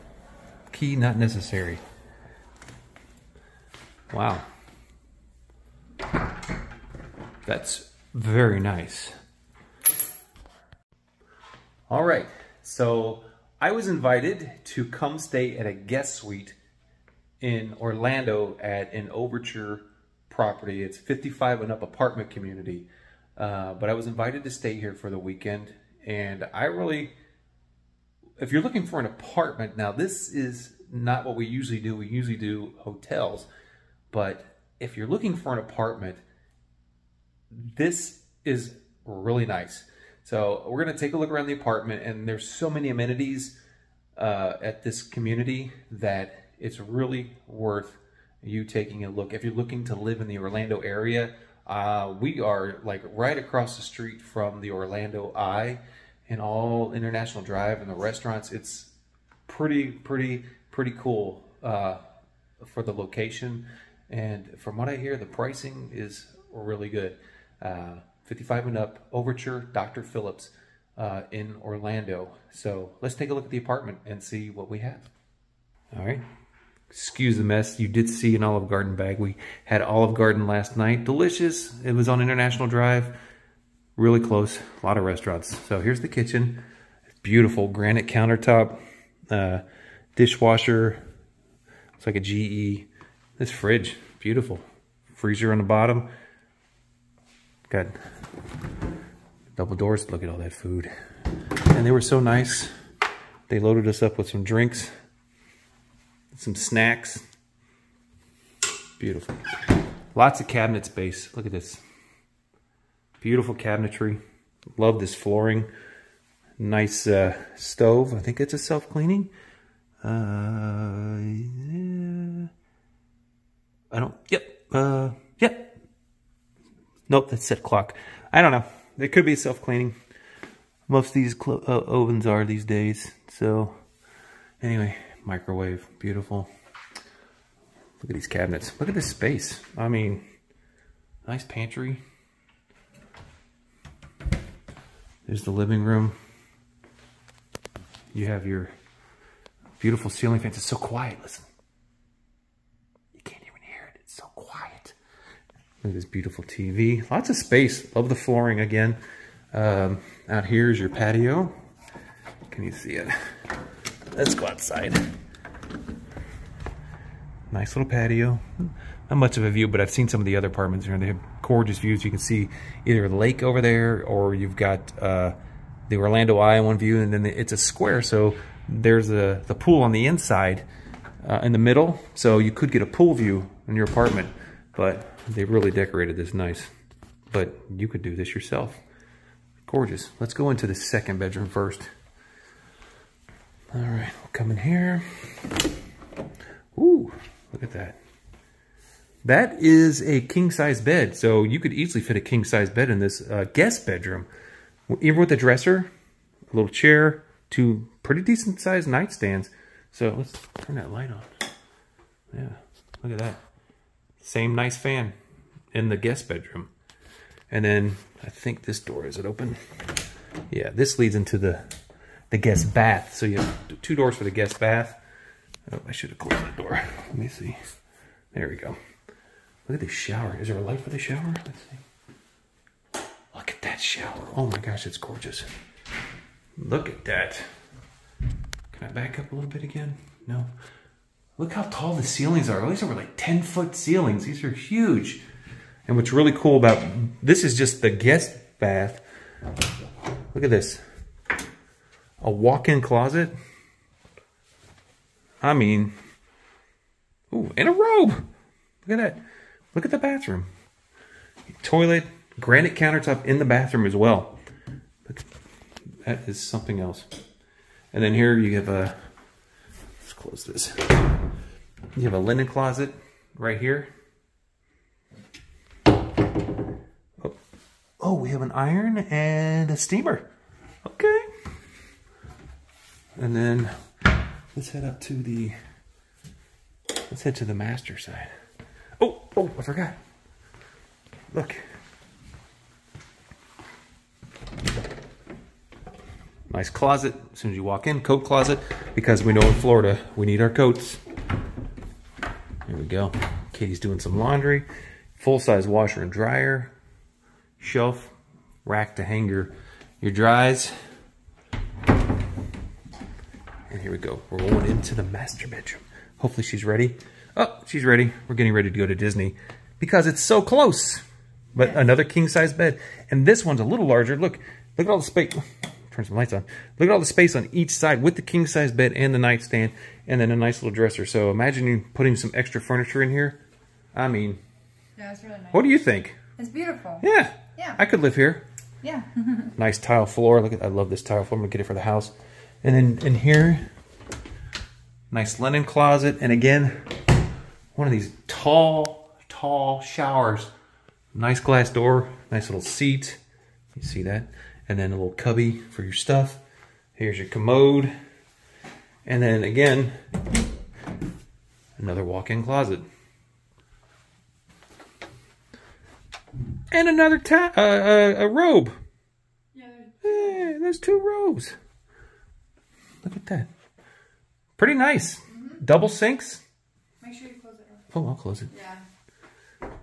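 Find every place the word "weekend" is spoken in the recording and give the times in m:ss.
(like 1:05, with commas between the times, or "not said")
0:25.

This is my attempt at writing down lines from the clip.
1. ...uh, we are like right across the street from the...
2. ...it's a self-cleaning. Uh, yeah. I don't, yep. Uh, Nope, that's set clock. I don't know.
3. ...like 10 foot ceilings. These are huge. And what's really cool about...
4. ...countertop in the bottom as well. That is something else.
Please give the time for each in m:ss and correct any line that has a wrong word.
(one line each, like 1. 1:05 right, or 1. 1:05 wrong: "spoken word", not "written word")
1. 0:51 right
2. 1:58 right
3. 4:02 right
4. 4:22 wrong: "bathroom", not "bottom".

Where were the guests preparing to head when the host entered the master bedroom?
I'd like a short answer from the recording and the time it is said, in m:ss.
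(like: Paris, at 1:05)
Disney, at 5:18.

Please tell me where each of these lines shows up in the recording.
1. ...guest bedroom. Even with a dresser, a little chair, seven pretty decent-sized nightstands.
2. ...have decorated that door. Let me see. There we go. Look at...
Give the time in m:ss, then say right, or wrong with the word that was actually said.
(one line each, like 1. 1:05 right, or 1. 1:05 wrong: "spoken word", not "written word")
1. 3:23 wrong: "two", not "seven"
2. 3:46 wrong: "closed", not "decorated".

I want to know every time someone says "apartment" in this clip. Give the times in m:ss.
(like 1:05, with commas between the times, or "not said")
0:21, 0:29, 0:35, 0:41, 1:13, 2:50, 3:03.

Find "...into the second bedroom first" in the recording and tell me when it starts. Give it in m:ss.
3:10.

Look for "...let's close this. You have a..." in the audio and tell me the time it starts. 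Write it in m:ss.
4:29.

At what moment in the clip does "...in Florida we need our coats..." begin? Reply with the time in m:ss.
4:59.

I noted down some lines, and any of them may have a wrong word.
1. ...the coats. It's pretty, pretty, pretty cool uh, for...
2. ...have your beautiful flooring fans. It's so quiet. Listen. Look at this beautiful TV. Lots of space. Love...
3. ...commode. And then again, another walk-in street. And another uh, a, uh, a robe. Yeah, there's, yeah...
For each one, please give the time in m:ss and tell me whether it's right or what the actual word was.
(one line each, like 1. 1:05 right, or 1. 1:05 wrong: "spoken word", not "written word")
1. 0:57 wrong: "restaurants", not "coats"
2. 2:28 wrong: "ceiling", not "flooring"
3. 5:57 wrong: "closet", not "street".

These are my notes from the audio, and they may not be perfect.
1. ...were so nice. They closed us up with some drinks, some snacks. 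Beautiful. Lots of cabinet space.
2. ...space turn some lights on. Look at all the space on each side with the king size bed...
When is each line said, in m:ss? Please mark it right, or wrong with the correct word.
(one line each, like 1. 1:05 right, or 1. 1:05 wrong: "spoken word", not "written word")
1. 1:41 wrong: "loaded", not "closed"
2. 5:25 right.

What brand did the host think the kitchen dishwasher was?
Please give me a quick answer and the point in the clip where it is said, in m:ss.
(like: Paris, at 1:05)
GE, at 1:32.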